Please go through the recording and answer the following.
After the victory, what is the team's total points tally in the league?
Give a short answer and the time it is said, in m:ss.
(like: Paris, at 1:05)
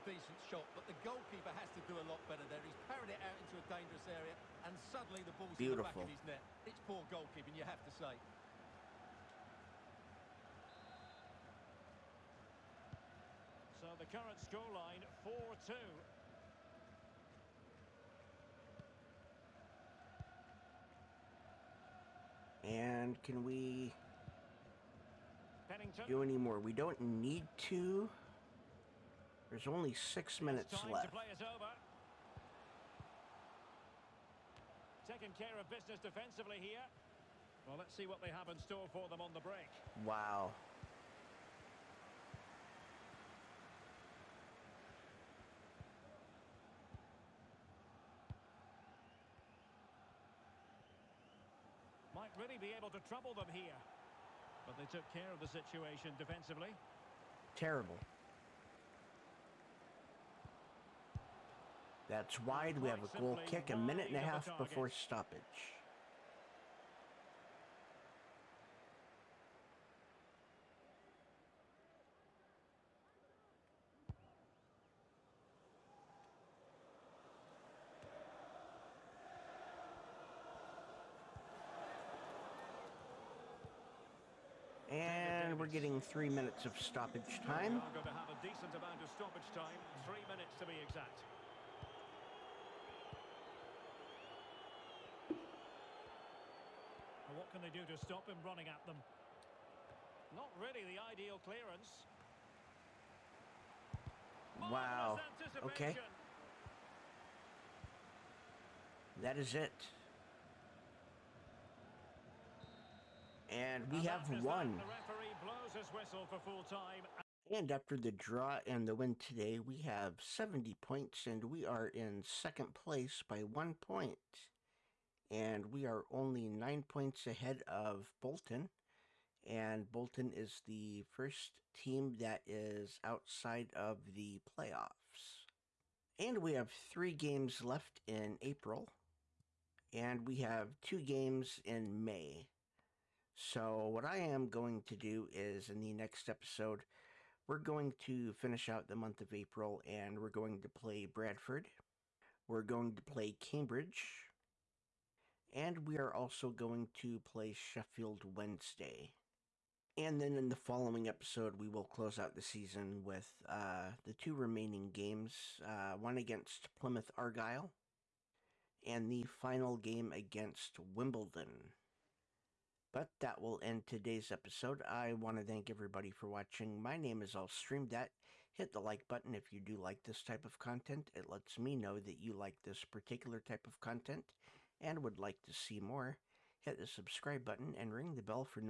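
70, at 2:00.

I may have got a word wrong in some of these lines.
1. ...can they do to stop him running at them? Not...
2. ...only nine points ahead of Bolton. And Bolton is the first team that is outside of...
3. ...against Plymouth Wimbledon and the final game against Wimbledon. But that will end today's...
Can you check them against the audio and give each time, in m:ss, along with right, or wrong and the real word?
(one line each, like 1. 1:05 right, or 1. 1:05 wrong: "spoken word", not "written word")
1. 1:37 right
2. 2:06 right
3. 2:46 wrong: "Argyle", not "Wimbledon".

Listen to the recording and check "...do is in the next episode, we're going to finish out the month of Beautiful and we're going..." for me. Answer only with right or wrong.
wrong.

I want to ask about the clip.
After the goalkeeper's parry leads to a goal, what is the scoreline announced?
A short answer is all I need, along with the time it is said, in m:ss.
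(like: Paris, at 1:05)
4-2, at 0:15.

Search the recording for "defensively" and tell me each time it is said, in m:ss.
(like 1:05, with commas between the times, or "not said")
0:36, 0:56.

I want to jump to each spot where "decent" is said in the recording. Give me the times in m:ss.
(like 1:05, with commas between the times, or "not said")
0:00, 1:28.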